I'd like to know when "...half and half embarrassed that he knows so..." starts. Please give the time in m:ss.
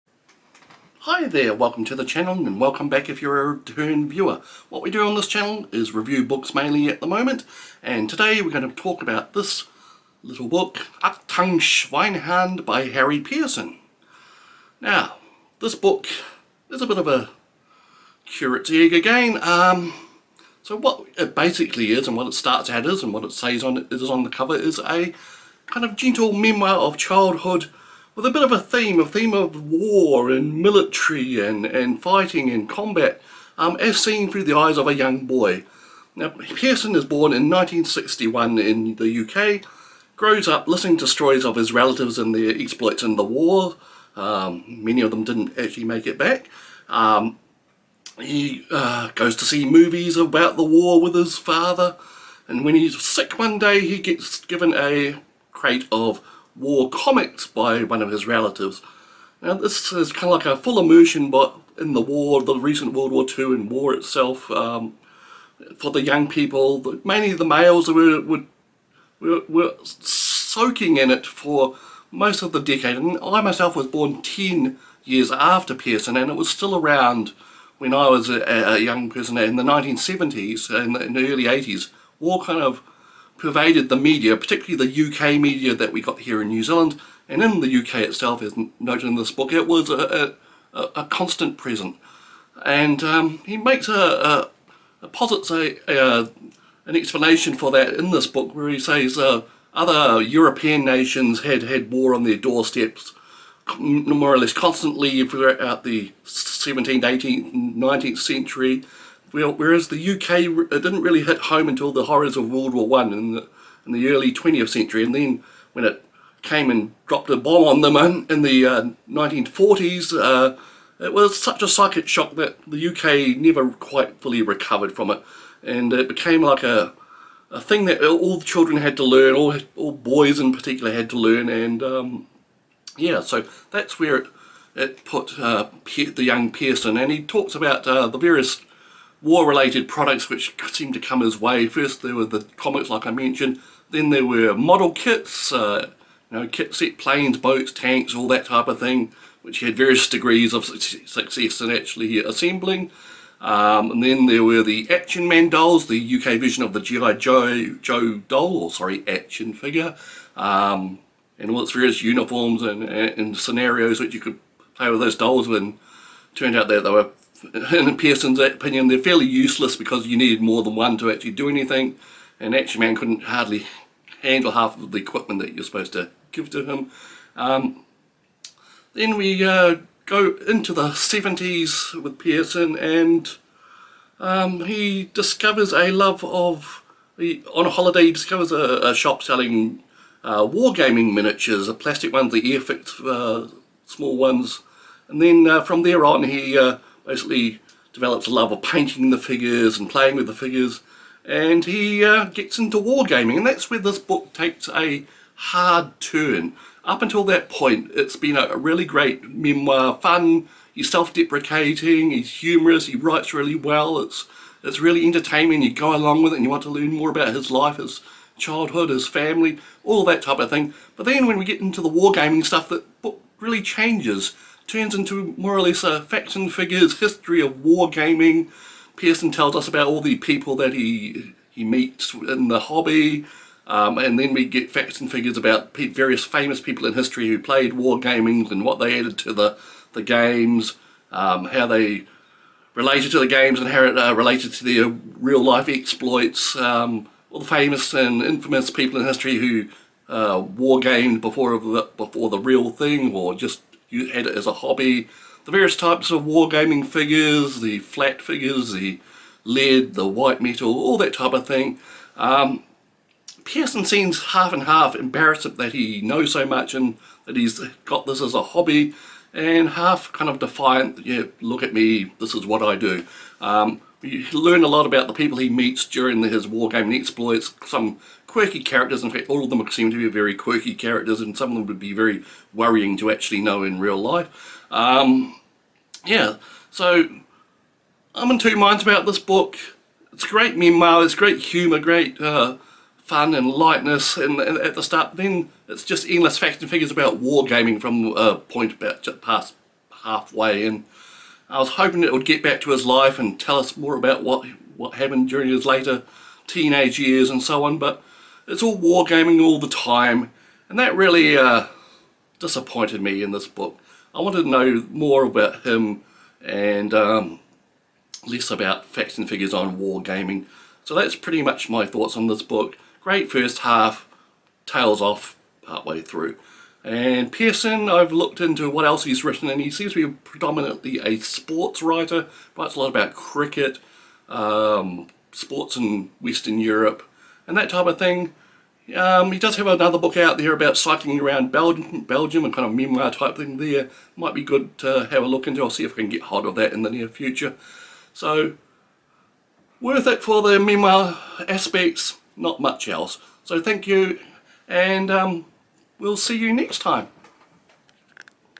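4:24.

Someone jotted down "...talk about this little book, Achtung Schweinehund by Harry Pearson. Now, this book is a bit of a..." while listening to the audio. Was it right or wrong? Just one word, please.
right.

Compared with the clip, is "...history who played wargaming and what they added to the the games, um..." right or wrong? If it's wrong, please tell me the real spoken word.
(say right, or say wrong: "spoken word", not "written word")
right.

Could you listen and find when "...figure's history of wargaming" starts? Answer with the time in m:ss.
3:46.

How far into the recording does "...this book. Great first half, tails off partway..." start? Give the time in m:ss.
5:22.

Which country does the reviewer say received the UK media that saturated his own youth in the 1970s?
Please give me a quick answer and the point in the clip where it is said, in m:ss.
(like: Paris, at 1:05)
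New Zealand, at 1:26.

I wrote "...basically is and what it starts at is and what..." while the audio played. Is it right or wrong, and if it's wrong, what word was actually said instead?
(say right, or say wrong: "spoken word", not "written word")
right.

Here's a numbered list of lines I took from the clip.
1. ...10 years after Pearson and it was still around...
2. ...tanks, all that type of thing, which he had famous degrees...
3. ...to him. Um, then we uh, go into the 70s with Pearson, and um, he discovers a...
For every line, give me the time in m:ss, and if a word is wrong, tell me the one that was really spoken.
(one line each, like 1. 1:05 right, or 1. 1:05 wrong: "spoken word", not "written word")
1. 1:14 right
2. 2:27 wrong: "various", not "famous"
3. 2:56 right.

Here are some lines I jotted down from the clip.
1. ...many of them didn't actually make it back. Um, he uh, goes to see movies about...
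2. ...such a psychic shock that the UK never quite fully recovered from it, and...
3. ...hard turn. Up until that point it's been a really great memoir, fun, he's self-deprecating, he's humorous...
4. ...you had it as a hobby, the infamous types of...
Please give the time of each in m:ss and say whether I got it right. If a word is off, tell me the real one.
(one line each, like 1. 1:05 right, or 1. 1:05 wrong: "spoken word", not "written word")
1. 0:44 right
2. 2:01 right
3. 3:25 right
4. 4:13 wrong: "various", not "infamous".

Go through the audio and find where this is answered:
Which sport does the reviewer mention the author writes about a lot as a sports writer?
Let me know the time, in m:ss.
5:33.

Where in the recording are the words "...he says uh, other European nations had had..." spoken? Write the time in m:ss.
1:38.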